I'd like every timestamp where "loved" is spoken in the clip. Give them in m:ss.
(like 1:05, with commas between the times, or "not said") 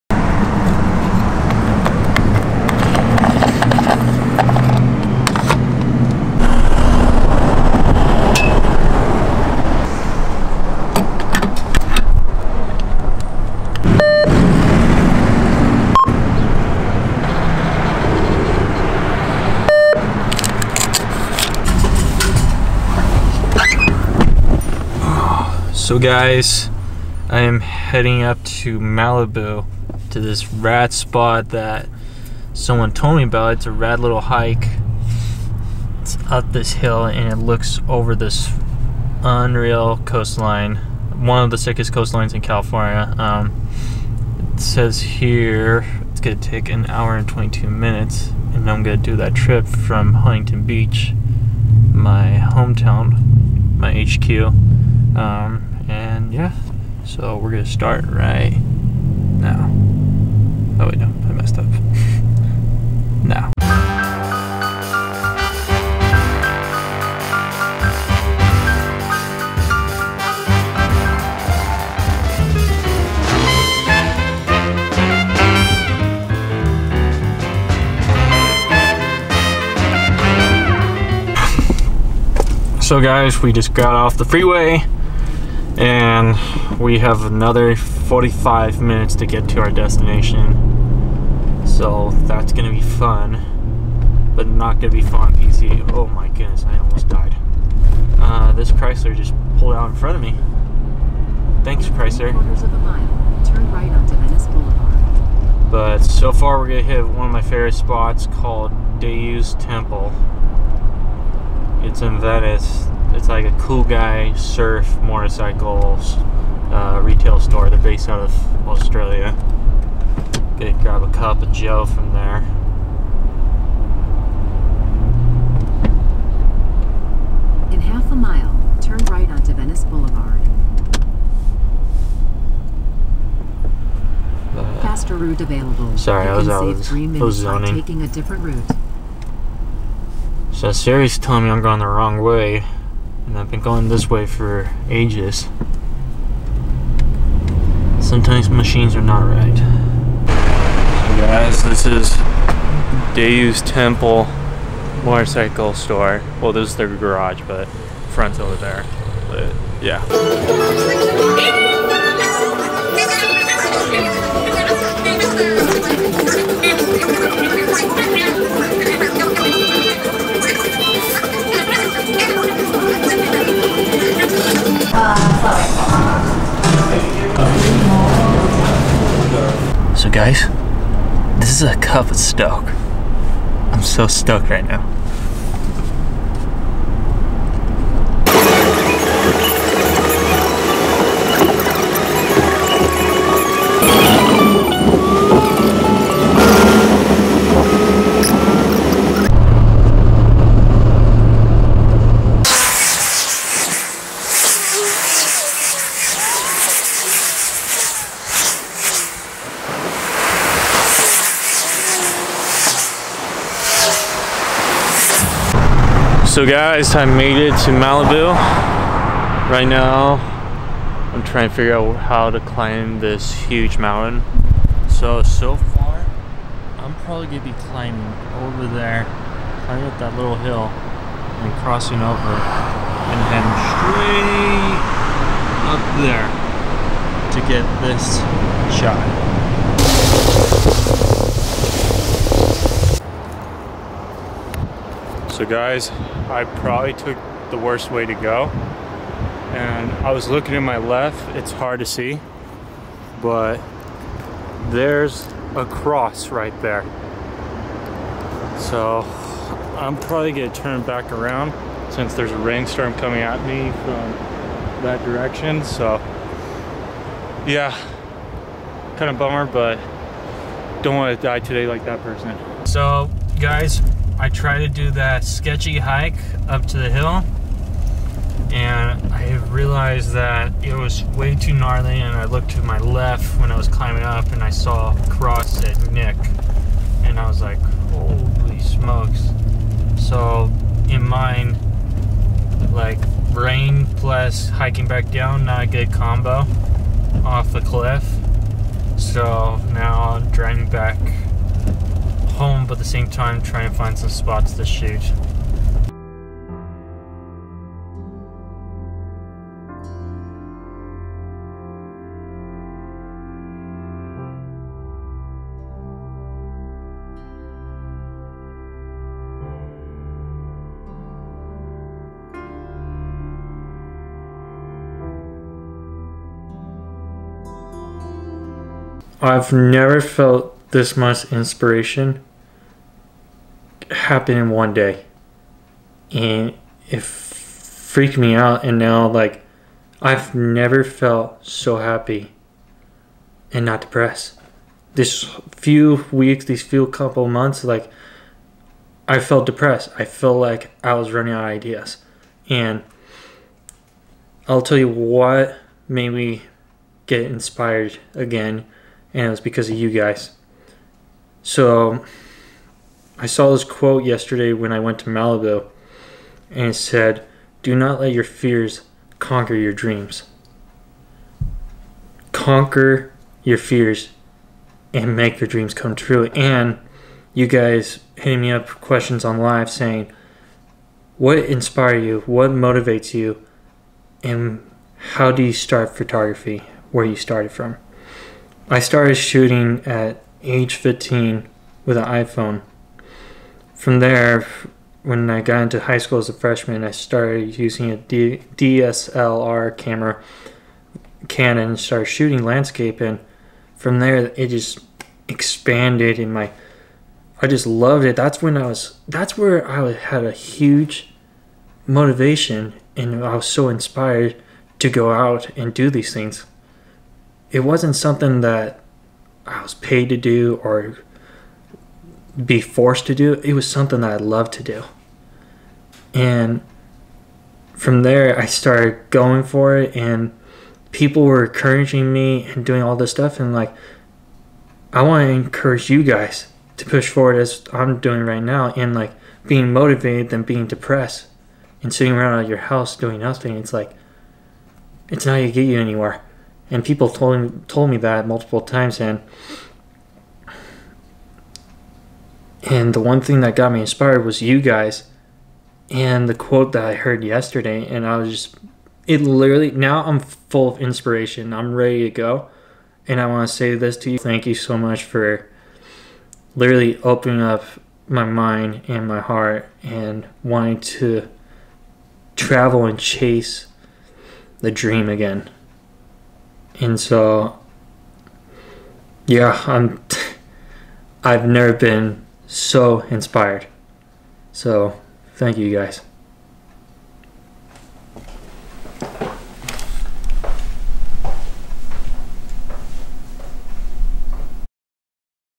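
6:47, 7:04.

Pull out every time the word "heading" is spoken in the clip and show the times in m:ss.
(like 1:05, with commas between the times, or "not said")
0:27, 3:53.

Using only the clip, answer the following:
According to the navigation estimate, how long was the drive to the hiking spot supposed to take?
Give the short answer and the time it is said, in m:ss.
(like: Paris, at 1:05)
1 hour 22 minutes, at 0:46.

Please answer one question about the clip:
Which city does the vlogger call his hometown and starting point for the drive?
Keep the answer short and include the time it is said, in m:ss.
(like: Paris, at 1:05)
Huntington Beach, at 0:50.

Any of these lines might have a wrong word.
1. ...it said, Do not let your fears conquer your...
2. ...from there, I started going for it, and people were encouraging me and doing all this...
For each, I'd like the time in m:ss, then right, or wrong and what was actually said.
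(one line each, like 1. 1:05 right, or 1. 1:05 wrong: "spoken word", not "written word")
1. 6:06 right
2. 7:07 right.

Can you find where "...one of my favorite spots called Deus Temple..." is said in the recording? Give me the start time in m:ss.
1:47.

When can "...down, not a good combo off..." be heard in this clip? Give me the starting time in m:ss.
4:55.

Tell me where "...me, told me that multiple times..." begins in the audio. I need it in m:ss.
7:27.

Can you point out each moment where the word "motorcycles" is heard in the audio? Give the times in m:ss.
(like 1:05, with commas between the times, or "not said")
1:55, 2:35.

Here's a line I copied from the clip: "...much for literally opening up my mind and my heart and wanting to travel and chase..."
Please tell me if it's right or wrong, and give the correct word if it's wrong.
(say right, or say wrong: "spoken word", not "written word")
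right.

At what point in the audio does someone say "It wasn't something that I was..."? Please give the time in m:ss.
6:57.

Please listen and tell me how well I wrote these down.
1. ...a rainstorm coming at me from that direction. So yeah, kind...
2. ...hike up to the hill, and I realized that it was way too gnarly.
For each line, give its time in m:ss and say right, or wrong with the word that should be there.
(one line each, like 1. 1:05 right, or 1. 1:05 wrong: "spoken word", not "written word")
1. 4:22 right
2. 4:35 right.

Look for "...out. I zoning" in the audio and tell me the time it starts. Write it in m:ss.
2:16.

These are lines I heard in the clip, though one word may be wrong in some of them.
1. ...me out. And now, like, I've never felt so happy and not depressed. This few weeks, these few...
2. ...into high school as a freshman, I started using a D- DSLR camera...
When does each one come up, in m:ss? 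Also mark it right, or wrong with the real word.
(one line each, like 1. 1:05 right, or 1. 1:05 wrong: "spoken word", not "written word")
1. 5:38 right
2. 6:35 right.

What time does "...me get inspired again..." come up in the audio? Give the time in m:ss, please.
5:56.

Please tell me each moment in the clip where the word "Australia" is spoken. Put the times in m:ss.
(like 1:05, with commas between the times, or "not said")
1:58.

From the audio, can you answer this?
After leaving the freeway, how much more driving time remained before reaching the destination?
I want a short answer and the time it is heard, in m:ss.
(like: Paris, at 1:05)
45 minutes, at 1:27.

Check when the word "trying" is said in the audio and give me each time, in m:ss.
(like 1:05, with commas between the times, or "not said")
3:41, 5:03.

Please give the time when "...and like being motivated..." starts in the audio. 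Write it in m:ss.
7:18.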